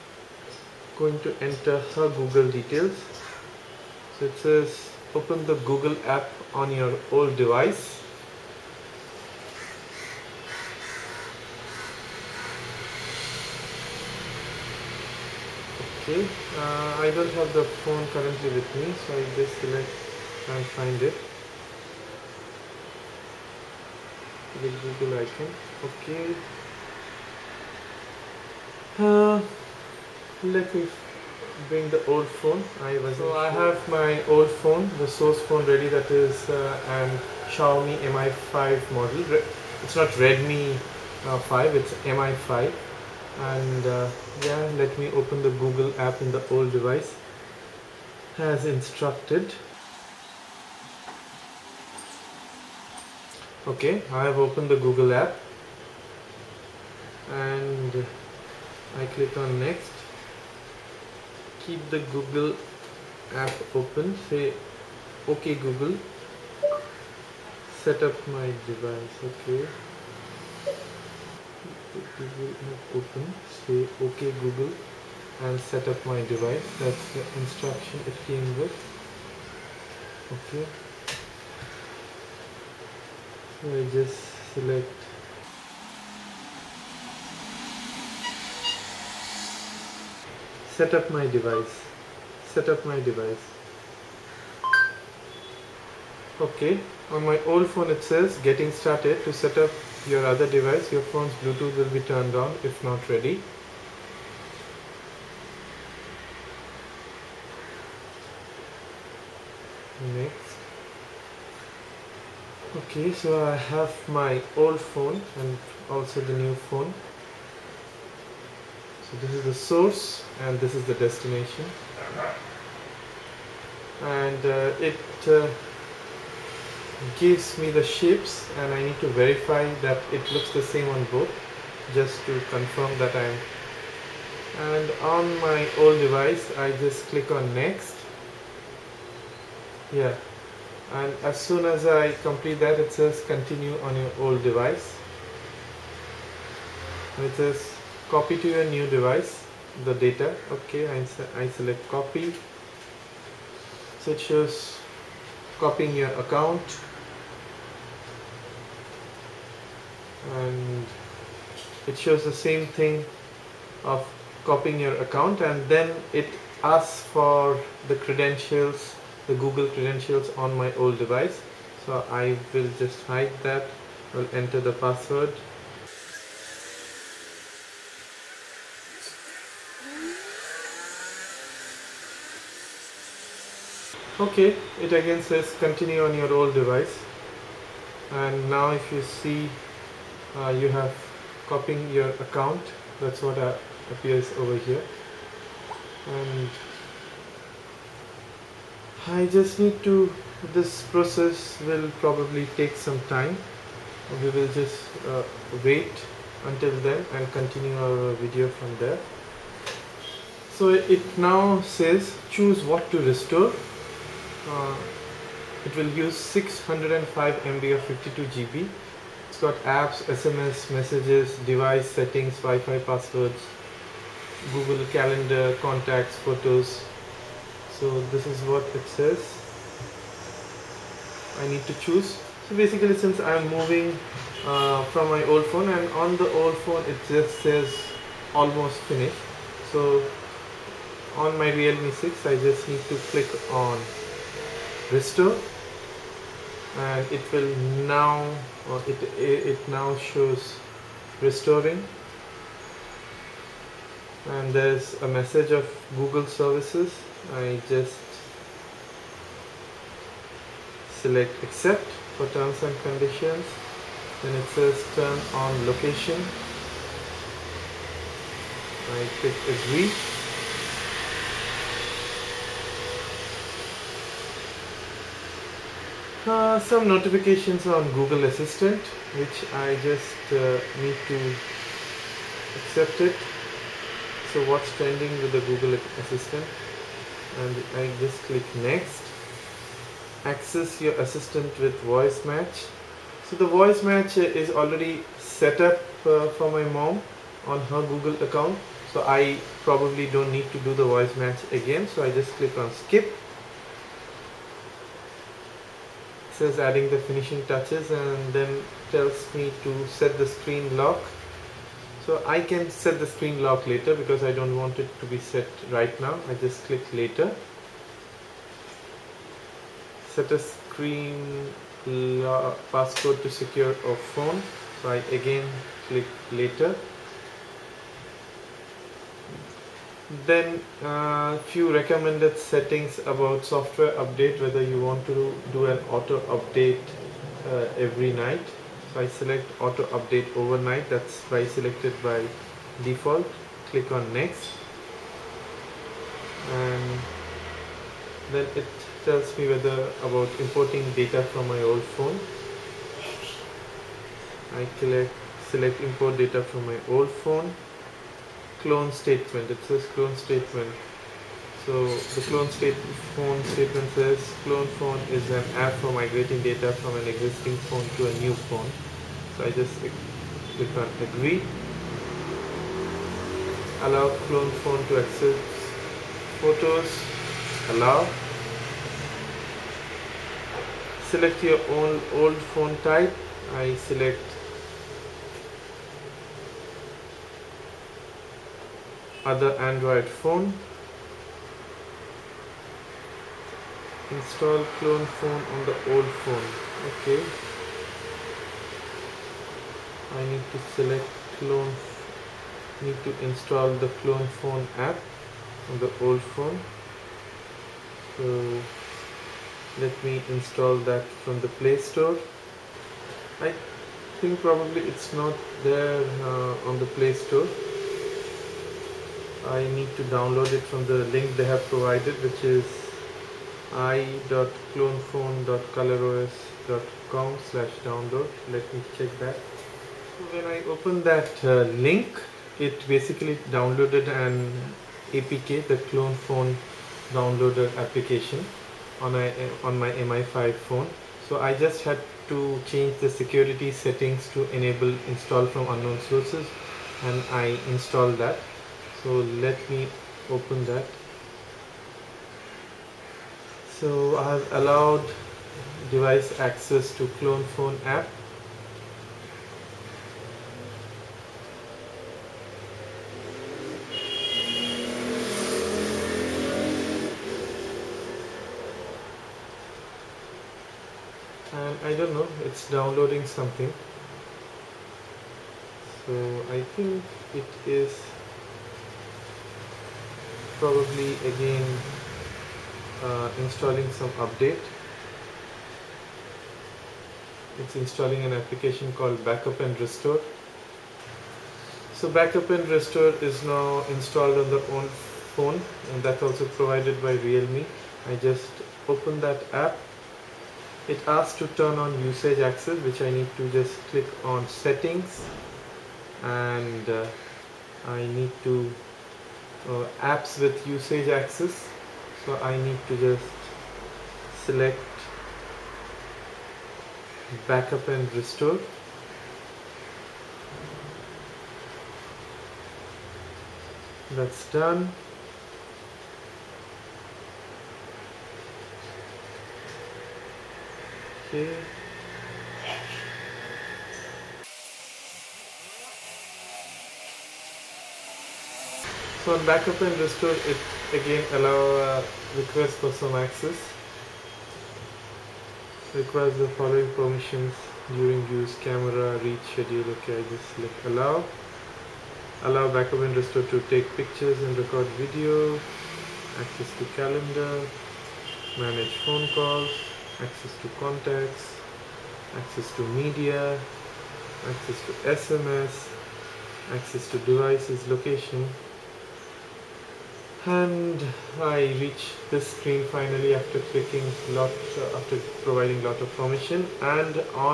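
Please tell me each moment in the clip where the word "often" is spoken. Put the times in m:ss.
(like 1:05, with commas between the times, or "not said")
not said.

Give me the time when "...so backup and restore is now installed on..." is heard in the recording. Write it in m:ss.
8:11.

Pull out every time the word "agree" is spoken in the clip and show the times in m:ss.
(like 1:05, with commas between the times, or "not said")
4:29, 6:11.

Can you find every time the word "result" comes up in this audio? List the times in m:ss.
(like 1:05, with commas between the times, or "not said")
not said.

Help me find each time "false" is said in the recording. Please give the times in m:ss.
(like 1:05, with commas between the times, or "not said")
not said.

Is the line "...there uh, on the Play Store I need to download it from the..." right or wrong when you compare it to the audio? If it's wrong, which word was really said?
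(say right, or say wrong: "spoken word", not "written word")
right.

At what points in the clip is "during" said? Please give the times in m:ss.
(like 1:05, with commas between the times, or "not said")
9:07.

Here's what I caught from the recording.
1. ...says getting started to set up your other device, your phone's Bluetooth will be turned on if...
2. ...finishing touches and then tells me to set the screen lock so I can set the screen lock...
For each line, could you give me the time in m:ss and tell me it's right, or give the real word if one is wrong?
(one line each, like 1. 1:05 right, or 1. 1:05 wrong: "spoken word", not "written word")
1. 1:38 right
2. 5:07 right.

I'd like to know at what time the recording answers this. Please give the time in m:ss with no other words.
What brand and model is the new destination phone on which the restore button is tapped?
4:01.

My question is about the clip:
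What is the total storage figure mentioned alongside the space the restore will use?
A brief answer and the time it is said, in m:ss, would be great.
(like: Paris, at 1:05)
52 GB, at 3:37.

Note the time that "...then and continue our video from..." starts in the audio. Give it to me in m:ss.
3:26.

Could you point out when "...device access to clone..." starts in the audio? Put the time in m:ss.
7:35.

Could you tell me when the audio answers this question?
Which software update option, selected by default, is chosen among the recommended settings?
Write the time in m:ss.
5:39.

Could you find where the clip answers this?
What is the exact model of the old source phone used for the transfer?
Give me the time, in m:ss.
0:37.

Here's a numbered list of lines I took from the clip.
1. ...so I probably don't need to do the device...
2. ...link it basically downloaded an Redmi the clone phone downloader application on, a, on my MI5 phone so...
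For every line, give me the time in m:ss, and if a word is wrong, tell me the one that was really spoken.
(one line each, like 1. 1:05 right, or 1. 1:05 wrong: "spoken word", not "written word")
1. 4:58 wrong: "voice", not "device"
2. 7:11 wrong: "APK", not "Redmi".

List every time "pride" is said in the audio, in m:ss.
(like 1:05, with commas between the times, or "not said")
not said.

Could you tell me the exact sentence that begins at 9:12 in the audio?
Allow backup and restore to take pictures and record video.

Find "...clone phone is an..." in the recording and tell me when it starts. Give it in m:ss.
6:04.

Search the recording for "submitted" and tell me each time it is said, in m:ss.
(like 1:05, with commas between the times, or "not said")
not said.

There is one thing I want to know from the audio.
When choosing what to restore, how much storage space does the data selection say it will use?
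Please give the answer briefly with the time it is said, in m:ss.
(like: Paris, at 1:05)
605 MB, at 3:36.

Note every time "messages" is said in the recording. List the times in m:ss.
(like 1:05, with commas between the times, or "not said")
3:40, 4:15.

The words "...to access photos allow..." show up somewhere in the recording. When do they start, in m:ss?
6:14.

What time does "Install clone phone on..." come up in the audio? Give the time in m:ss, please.
6:34.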